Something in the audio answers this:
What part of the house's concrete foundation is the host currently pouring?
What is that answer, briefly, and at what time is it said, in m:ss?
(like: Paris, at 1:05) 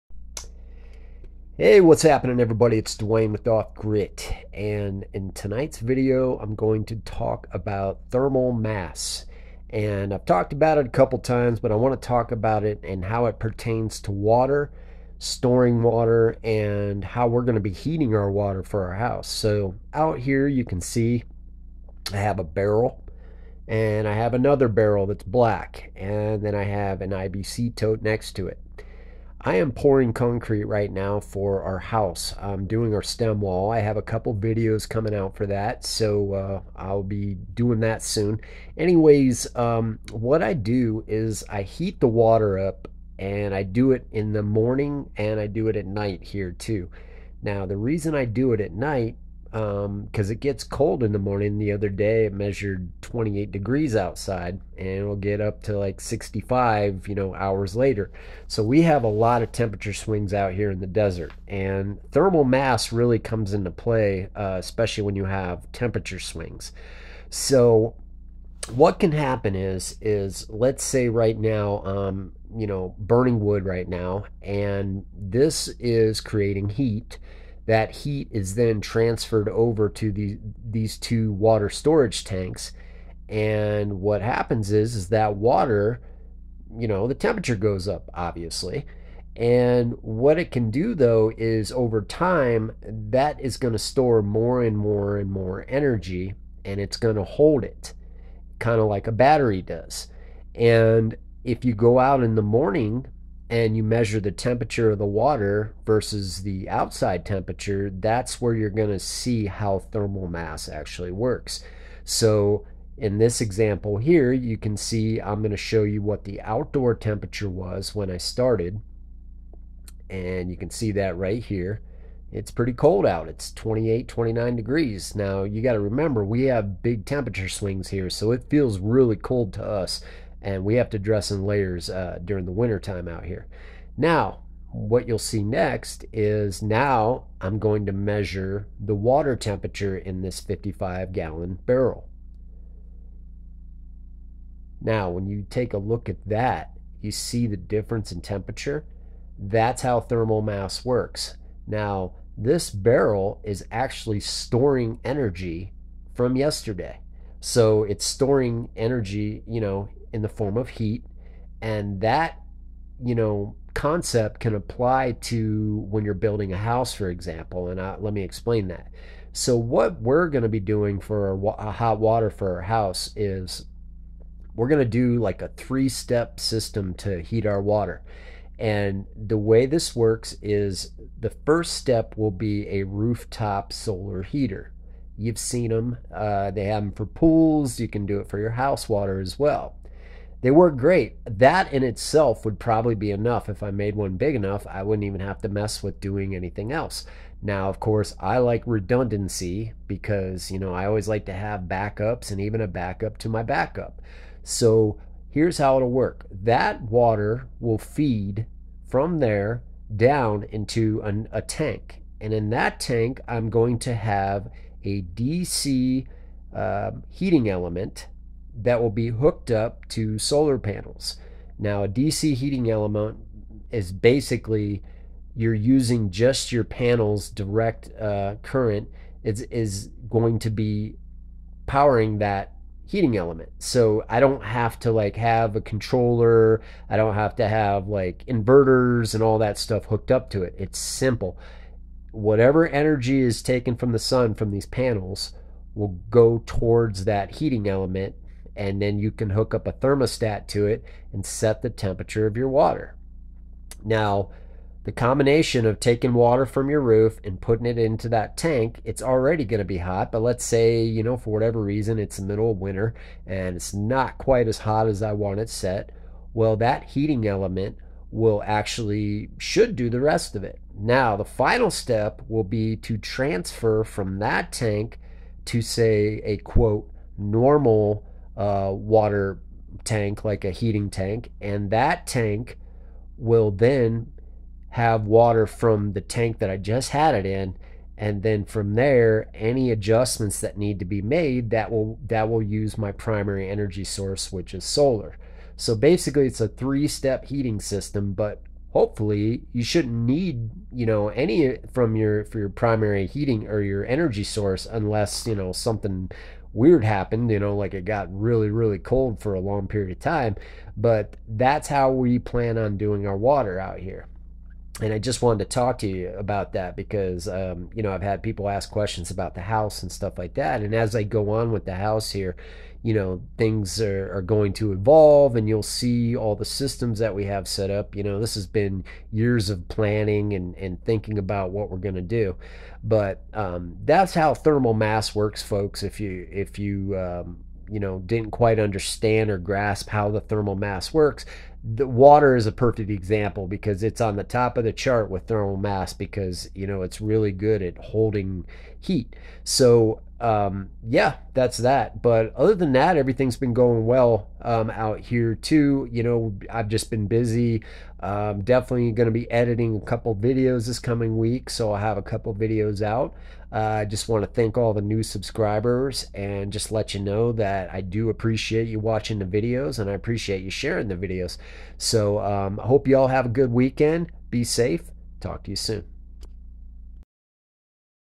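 stem wall, at 0:33.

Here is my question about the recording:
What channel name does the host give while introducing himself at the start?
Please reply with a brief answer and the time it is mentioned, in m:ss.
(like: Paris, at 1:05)
Off Grit, at 0:03.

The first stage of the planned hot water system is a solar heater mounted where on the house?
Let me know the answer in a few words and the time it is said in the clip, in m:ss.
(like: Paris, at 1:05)
rooftop, at 3:02.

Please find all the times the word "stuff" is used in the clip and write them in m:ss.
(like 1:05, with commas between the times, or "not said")
3:59, 5:19.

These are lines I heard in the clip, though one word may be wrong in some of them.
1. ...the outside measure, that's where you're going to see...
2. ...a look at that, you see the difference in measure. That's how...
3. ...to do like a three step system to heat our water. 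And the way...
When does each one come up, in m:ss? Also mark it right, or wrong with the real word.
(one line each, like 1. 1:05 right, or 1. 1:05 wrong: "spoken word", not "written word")
1. 1:46 wrong: "temperature", not "measure"
2. 2:25 wrong: "temperature", not "measure"
3. 2:54 right.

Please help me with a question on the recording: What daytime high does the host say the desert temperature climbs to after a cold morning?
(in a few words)
65.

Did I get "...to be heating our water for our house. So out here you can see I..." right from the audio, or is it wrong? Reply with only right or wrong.
right.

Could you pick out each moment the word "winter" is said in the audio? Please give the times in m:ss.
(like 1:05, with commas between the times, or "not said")
2:12, 4:22.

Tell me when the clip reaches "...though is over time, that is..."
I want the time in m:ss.
1:30.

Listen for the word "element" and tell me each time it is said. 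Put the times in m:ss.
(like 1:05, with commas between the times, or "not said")
3:37, 3:42, 3:53, 4:07, 4:27.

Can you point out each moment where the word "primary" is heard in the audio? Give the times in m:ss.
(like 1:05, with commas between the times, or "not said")
4:52, 5:02.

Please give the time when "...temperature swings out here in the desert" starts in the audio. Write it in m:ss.
0:59.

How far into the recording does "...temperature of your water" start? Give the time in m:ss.
4:11.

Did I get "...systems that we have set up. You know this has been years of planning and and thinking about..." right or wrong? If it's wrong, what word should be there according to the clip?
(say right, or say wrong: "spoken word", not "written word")
right.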